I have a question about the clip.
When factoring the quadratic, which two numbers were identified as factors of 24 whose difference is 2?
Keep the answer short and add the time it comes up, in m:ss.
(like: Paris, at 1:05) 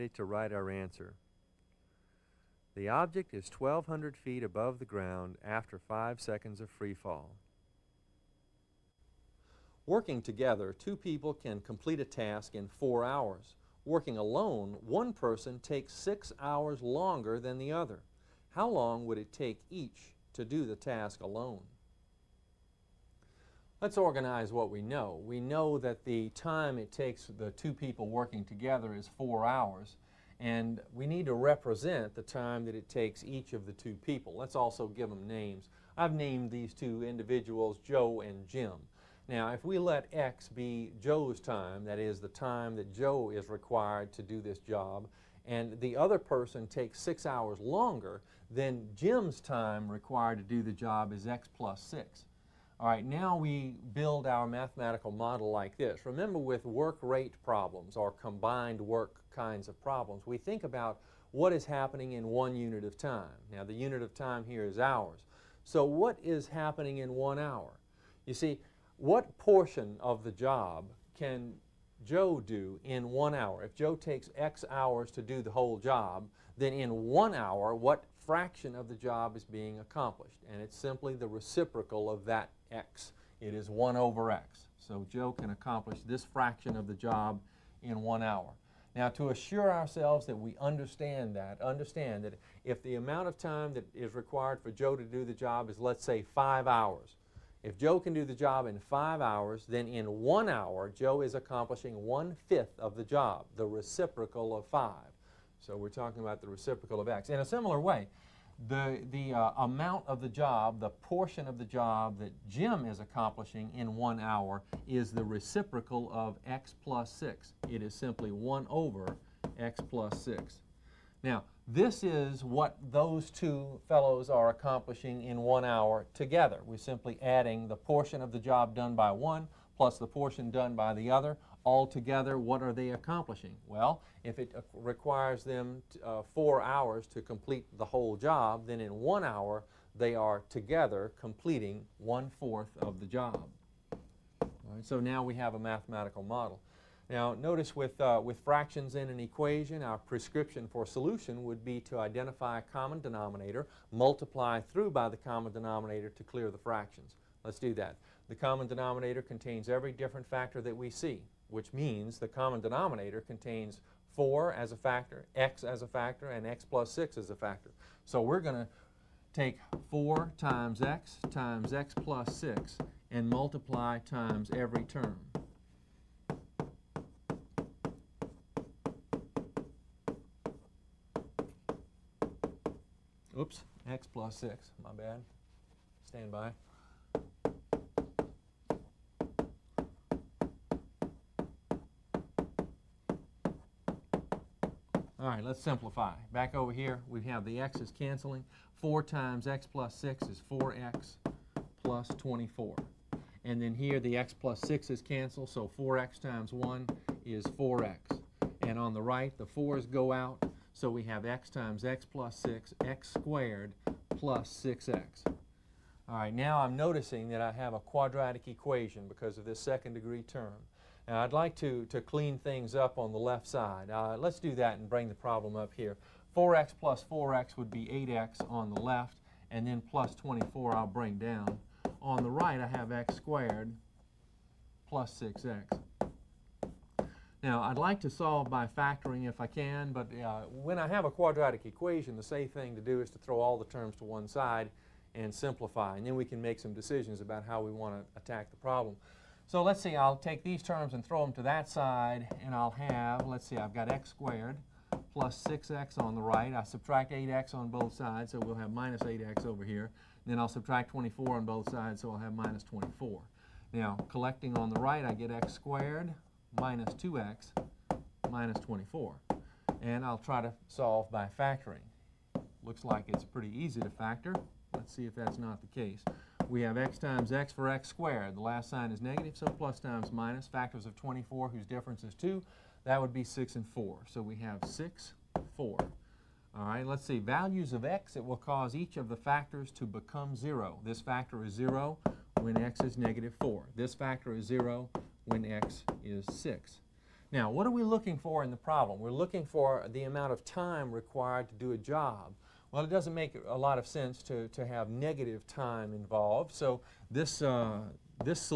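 6 and 4, at 4:43.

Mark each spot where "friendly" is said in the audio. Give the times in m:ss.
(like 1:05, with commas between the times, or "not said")
not said.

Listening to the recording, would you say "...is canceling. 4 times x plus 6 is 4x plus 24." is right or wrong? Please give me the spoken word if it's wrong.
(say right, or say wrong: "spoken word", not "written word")
right.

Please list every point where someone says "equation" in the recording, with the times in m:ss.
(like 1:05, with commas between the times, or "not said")
2:29, 3:38, 4:01.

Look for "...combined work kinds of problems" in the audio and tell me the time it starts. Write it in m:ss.
0:58.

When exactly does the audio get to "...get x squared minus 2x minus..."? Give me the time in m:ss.
4:25.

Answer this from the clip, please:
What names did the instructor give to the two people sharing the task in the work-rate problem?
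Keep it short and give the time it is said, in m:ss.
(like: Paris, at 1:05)
Joe and Jim, at 0:37.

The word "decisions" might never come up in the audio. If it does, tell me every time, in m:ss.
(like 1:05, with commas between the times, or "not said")
4:06.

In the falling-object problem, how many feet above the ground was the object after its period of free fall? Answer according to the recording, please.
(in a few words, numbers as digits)
1,200 feet.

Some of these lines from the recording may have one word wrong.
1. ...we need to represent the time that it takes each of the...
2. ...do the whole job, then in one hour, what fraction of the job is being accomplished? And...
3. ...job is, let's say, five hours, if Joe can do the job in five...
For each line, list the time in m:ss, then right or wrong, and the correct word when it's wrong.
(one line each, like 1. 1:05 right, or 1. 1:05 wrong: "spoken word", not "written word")
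1. 0:30 right
2. 1:15 right
3. 1:35 right.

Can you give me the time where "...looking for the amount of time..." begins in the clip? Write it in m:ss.
4:59.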